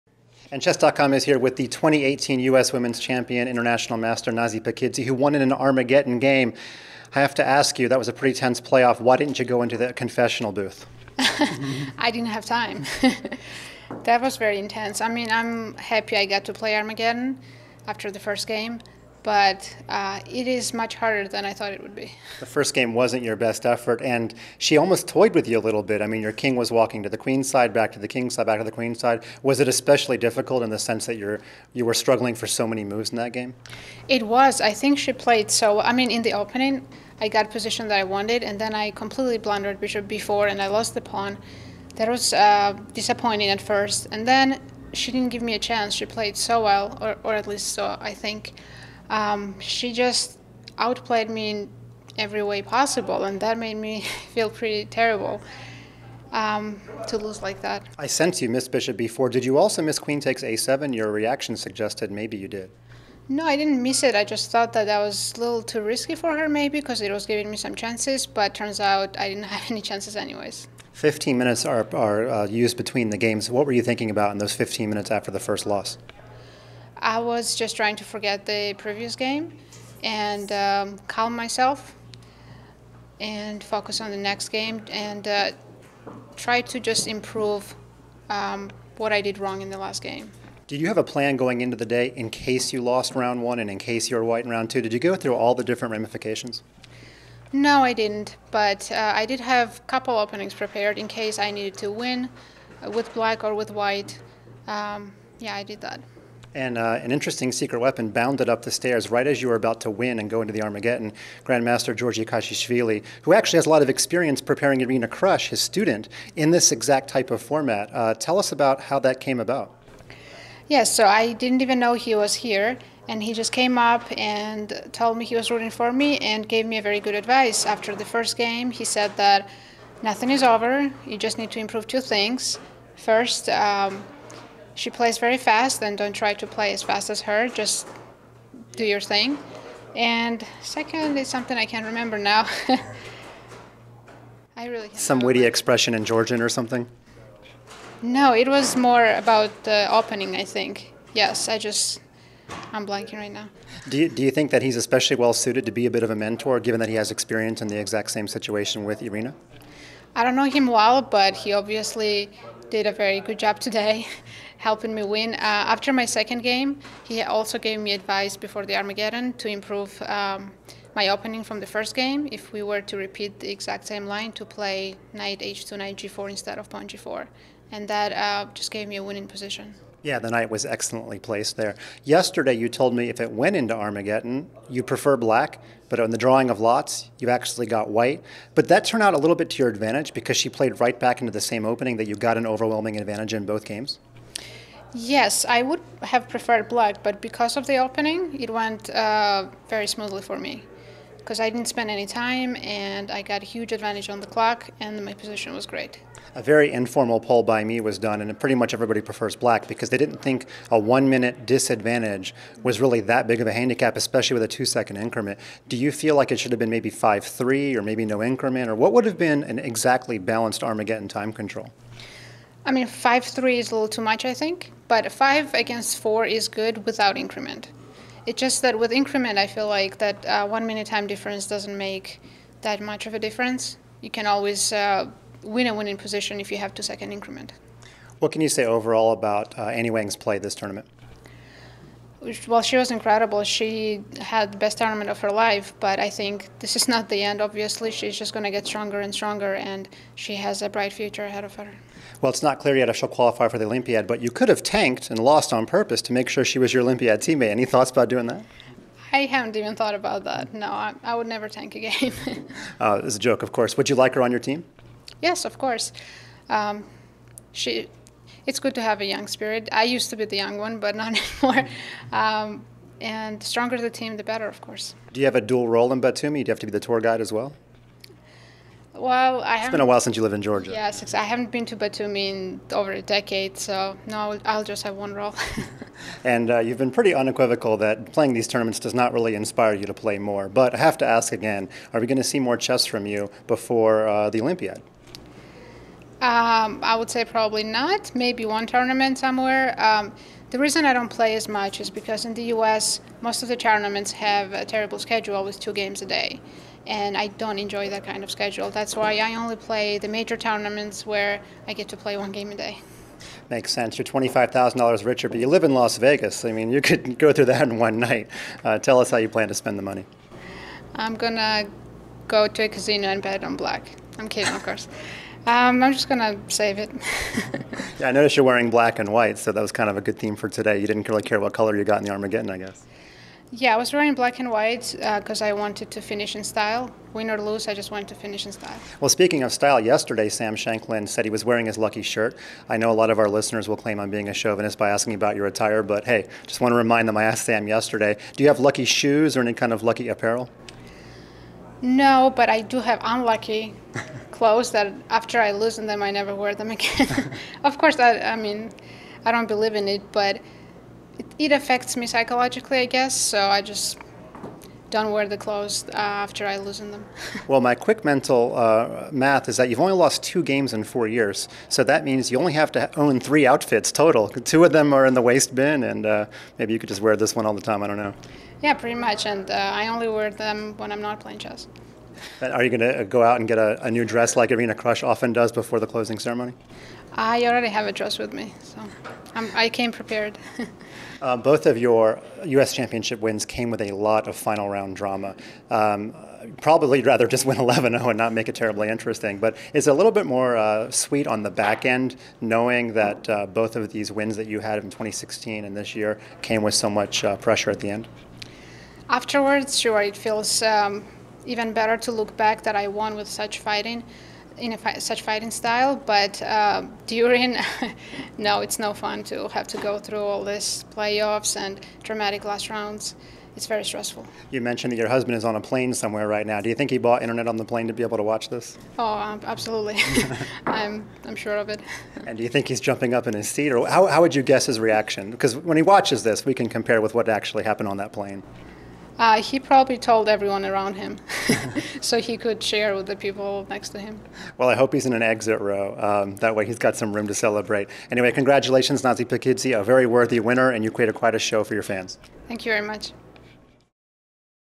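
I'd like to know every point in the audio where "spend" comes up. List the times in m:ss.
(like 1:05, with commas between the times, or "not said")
3:21, 5:19.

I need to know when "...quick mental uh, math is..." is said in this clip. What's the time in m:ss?
6:07.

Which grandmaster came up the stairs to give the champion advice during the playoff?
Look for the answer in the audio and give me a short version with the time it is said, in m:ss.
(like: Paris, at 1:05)
Georgi Kacheishvili, at 1:51.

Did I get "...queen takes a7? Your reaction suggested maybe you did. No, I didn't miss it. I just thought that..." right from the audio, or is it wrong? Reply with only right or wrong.
right.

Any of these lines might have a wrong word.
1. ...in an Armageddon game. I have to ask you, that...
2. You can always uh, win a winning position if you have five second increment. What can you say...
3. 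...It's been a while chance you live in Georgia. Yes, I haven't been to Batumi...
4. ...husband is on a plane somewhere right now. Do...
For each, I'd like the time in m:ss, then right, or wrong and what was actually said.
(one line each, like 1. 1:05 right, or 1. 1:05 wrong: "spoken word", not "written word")
1. 0:05 right
2. 3:54 wrong: "two", not "five"
3. 4:39 wrong: "since", not "chance"
4. 7:05 right.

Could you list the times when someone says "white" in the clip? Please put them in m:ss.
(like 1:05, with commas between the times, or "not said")
1:34, 1:43, 3:07, 5:29, 5:34.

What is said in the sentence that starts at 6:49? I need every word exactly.
Afterwards, sure, it feels um, even better to look back that I won with such fighting, in fi such fighting style.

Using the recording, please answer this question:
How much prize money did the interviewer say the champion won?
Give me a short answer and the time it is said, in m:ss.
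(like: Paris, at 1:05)
$25,000, at 5:14.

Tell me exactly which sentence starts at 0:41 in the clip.
That was uh, disappointing at first, and then she didn't give me a chance.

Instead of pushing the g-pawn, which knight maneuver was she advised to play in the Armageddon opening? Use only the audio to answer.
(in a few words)
knight h2, knight g4.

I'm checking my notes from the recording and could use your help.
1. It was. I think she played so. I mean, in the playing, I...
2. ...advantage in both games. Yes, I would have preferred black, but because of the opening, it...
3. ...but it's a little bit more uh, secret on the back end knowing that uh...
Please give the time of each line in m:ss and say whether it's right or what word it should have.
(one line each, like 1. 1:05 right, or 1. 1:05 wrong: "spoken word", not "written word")
1. 0:34 wrong: "opening", not "playing"
2. 3:12 right
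3. 6:39 wrong: "sweet", not "secret".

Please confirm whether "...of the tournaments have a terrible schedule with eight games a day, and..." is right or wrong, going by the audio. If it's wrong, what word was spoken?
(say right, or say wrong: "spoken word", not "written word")
wrong: "two", not "eight".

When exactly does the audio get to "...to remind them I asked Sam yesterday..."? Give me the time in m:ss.
5:46.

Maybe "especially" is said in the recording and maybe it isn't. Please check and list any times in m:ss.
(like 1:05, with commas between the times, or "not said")
0:29, 2:34, 3:33.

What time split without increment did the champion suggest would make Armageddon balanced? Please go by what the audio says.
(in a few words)
5 against 4.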